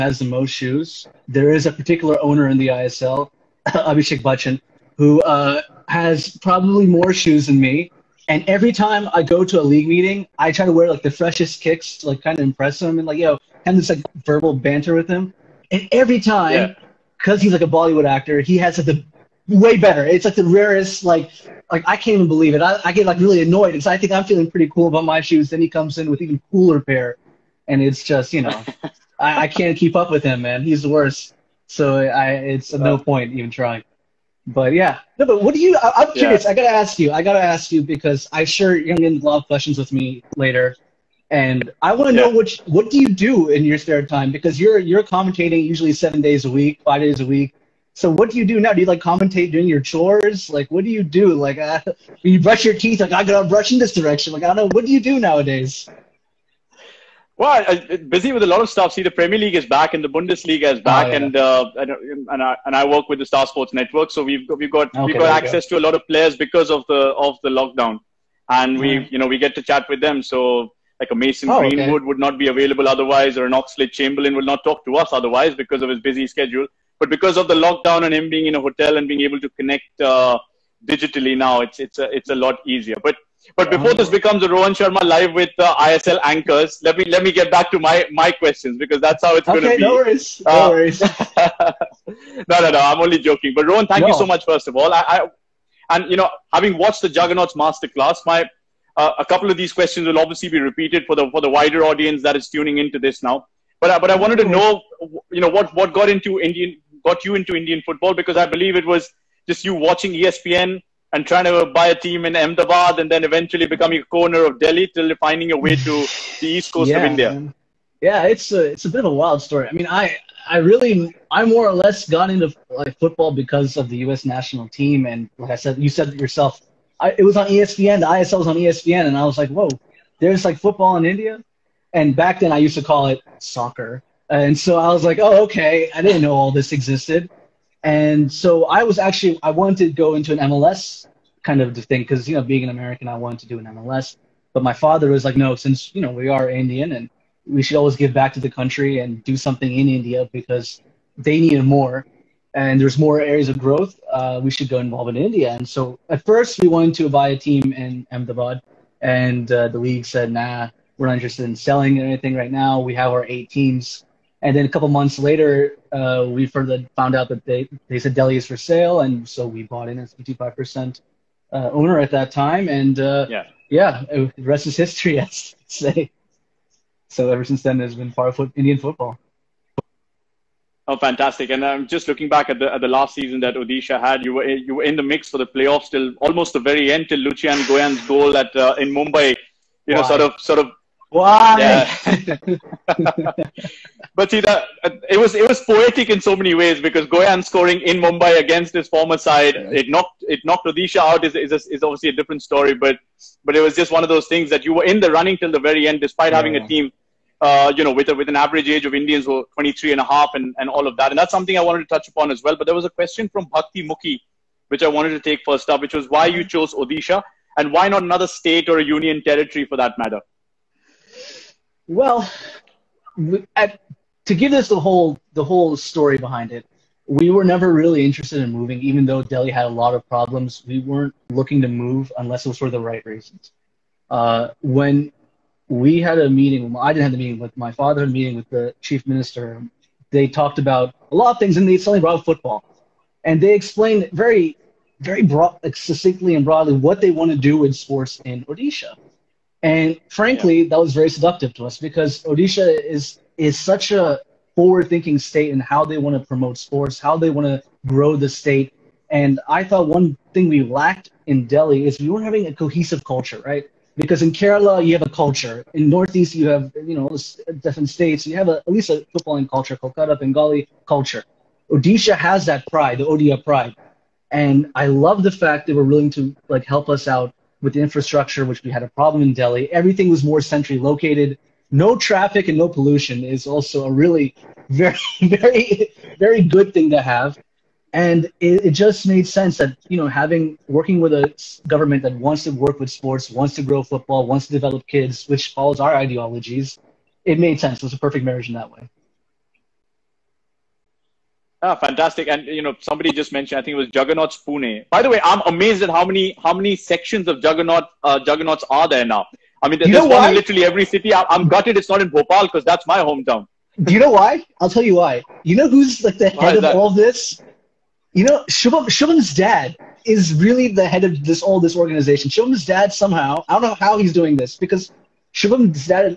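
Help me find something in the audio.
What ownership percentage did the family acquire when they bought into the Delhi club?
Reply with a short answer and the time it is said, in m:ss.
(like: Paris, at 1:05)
55%, at 2:50.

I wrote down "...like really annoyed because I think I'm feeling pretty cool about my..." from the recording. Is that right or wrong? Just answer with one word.
right.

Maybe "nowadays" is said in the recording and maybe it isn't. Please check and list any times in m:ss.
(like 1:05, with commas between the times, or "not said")
0:55.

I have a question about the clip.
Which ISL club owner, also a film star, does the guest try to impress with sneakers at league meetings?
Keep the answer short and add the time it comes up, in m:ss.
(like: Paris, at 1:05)
Abhishek Bachchan, at 0:03.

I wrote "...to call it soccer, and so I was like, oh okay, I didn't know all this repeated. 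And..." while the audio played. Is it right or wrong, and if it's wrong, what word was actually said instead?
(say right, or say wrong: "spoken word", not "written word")
wrong: "existed", not "repeated".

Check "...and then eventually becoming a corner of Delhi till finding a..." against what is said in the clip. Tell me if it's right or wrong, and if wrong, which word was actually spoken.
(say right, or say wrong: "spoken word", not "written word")
right.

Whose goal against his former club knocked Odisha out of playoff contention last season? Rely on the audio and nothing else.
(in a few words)
Lucian Goian.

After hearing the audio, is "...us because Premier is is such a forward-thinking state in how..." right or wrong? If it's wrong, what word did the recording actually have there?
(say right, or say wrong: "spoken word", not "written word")
wrong: "Odisha", not "Premier".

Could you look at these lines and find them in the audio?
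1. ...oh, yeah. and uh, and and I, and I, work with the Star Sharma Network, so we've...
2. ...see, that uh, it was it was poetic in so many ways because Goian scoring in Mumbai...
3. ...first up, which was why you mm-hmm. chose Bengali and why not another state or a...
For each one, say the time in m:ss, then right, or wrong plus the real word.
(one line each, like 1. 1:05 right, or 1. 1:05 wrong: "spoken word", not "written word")
1. 1:01 wrong: "Sports", not "Sharma"
2. 3:14 right
3. 3:35 wrong: "Odisha", not "Bengali".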